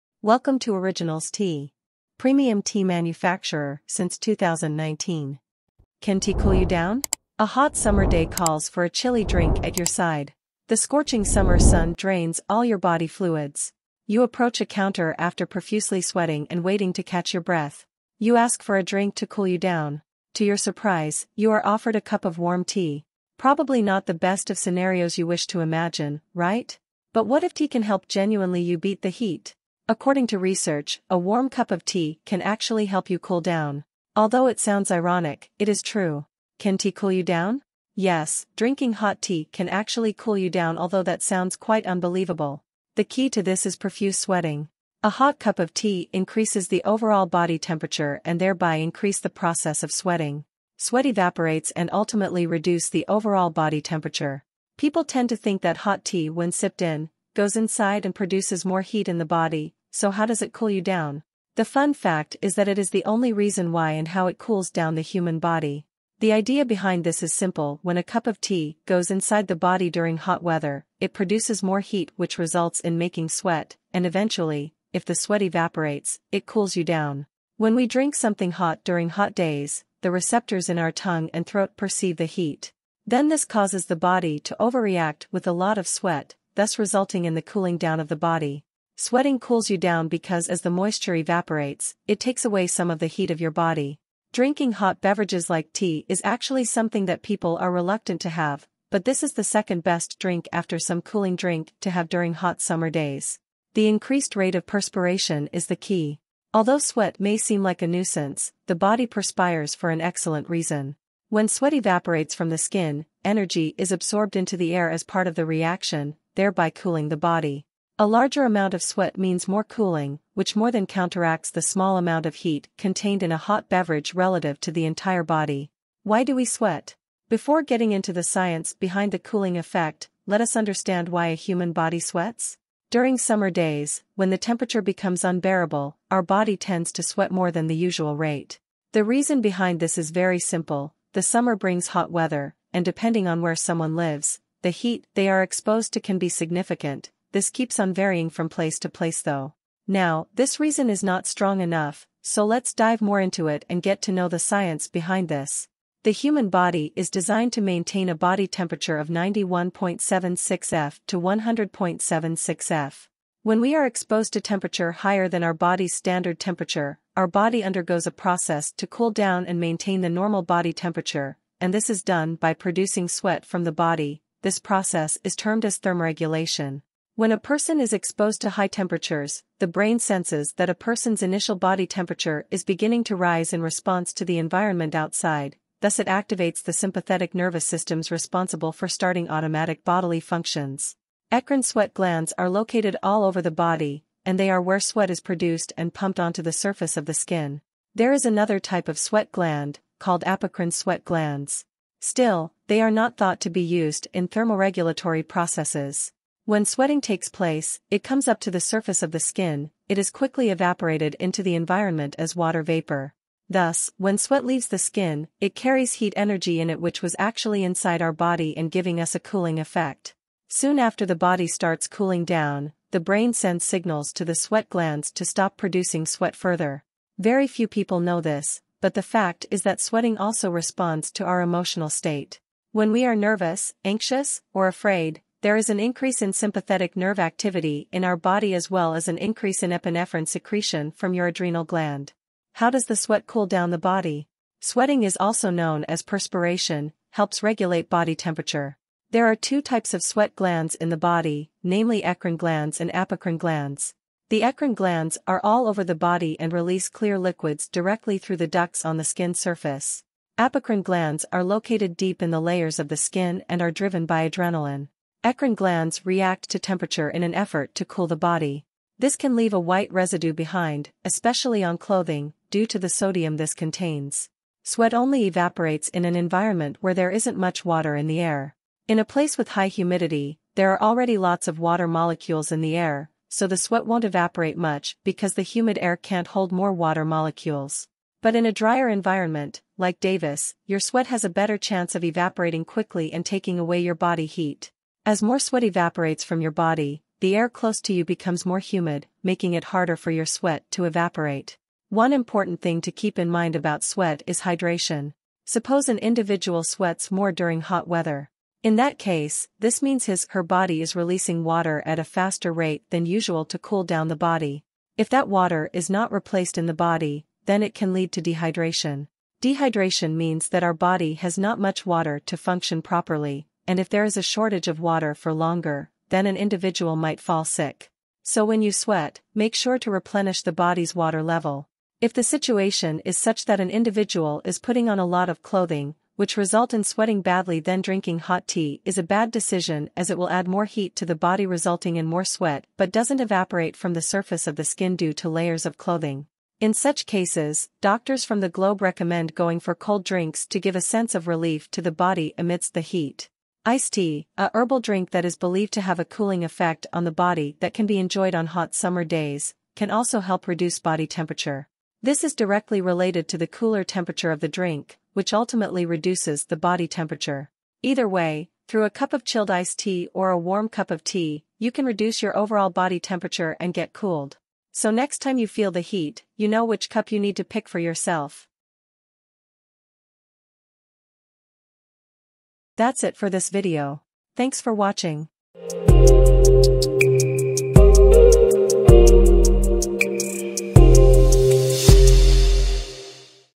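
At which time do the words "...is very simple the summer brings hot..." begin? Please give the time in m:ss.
2:19.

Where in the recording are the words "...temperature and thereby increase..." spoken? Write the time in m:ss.
0:47.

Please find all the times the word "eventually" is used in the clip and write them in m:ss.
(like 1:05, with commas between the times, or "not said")
1:14.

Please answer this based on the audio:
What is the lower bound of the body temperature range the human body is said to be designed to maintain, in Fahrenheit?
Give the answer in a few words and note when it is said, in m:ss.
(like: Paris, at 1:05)
91.76 F, at 2:39.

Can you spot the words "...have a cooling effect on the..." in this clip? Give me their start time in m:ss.
5:55.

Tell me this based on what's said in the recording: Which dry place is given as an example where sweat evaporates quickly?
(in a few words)
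Davis.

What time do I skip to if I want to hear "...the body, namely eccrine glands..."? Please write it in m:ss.
4:10.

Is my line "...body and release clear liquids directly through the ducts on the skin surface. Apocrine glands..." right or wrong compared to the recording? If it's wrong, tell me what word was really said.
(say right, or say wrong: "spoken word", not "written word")
right.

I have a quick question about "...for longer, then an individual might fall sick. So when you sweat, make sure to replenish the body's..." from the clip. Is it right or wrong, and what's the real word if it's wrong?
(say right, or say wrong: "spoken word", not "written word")
right.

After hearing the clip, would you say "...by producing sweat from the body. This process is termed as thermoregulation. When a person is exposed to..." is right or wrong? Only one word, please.
right.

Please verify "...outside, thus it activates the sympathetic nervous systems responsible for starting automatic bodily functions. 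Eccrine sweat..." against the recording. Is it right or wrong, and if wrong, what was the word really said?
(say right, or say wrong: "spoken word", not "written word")
right.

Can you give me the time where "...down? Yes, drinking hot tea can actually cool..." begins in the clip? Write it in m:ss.
0:37.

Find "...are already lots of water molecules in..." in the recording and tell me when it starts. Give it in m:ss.
4:40.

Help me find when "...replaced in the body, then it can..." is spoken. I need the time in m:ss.
5:16.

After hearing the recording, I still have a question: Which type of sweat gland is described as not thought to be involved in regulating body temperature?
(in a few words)
apocrine sweat glands.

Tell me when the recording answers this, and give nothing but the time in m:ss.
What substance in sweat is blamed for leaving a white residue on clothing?
4:32.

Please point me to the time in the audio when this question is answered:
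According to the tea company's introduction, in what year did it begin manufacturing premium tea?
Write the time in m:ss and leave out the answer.
0:04.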